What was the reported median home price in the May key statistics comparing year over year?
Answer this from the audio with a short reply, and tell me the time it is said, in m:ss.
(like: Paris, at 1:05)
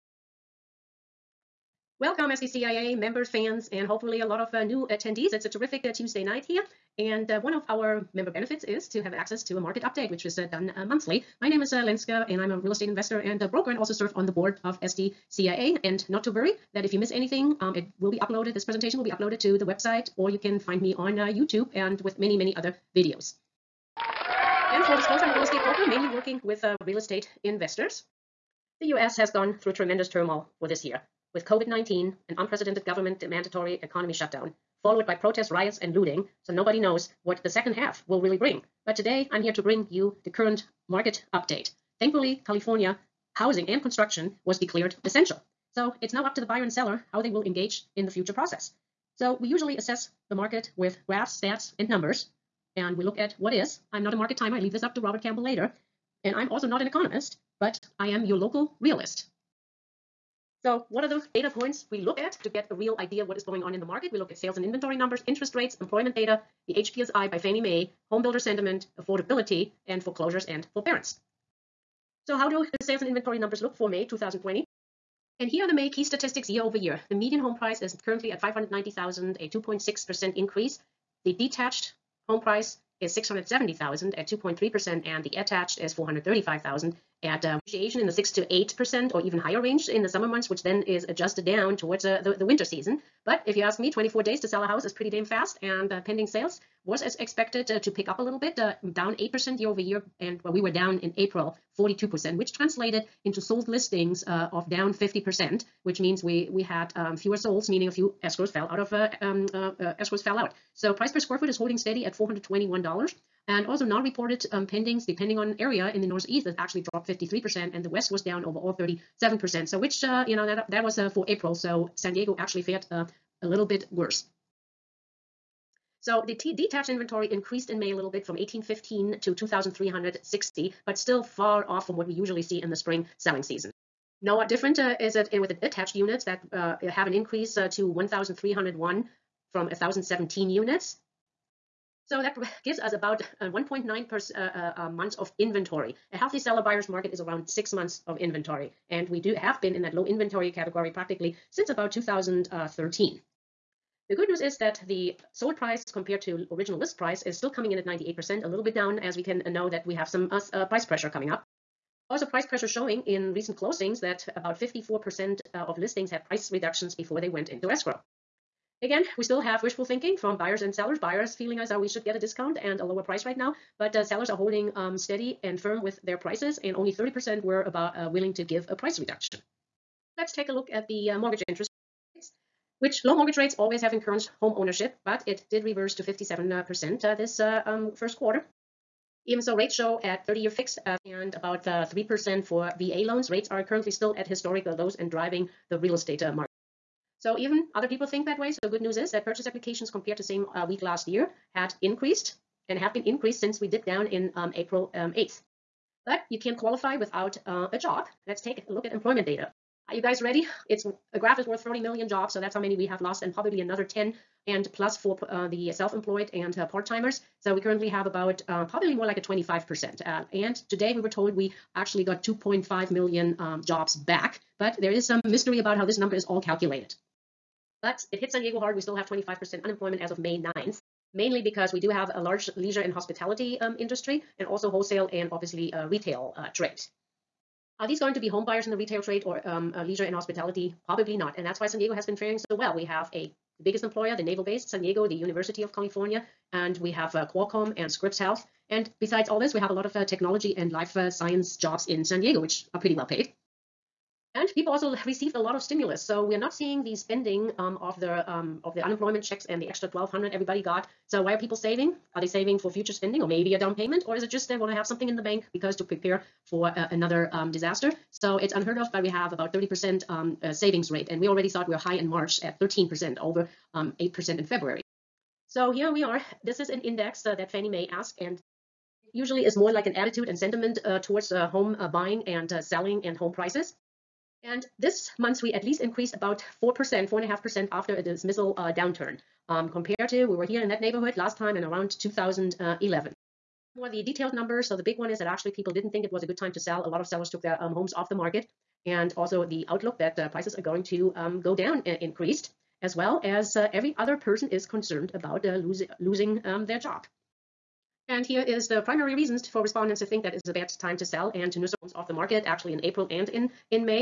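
590,000, at 1:18.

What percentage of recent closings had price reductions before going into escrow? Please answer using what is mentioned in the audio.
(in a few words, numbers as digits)
54%.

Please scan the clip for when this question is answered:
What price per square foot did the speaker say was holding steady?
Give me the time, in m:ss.
1:52.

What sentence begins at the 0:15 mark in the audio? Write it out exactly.
And not to worry, that if you miss anything, um, it will be uploaded.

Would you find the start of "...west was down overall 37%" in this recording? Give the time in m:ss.
1:57.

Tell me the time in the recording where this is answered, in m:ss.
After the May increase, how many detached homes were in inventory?
2:09.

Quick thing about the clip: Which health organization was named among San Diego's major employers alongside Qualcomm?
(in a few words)
Scripps Health.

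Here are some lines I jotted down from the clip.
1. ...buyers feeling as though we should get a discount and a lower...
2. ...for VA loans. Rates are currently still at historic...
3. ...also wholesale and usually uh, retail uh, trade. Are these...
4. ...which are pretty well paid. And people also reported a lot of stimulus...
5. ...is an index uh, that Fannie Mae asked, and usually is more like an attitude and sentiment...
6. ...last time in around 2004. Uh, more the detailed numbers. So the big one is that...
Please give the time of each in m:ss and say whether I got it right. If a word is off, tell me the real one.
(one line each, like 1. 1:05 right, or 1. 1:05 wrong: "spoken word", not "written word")
1. 2:50 right
2. 3:12 right
3. 3:54 wrong: "obviously", not "usually"
4. 4:12 wrong: "received", not "reported"
5. 4:36 right
6. 4:51 wrong: "2011", not "2004".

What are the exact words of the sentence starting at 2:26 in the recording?
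A healthy seller buyer's market is around six months of inventory.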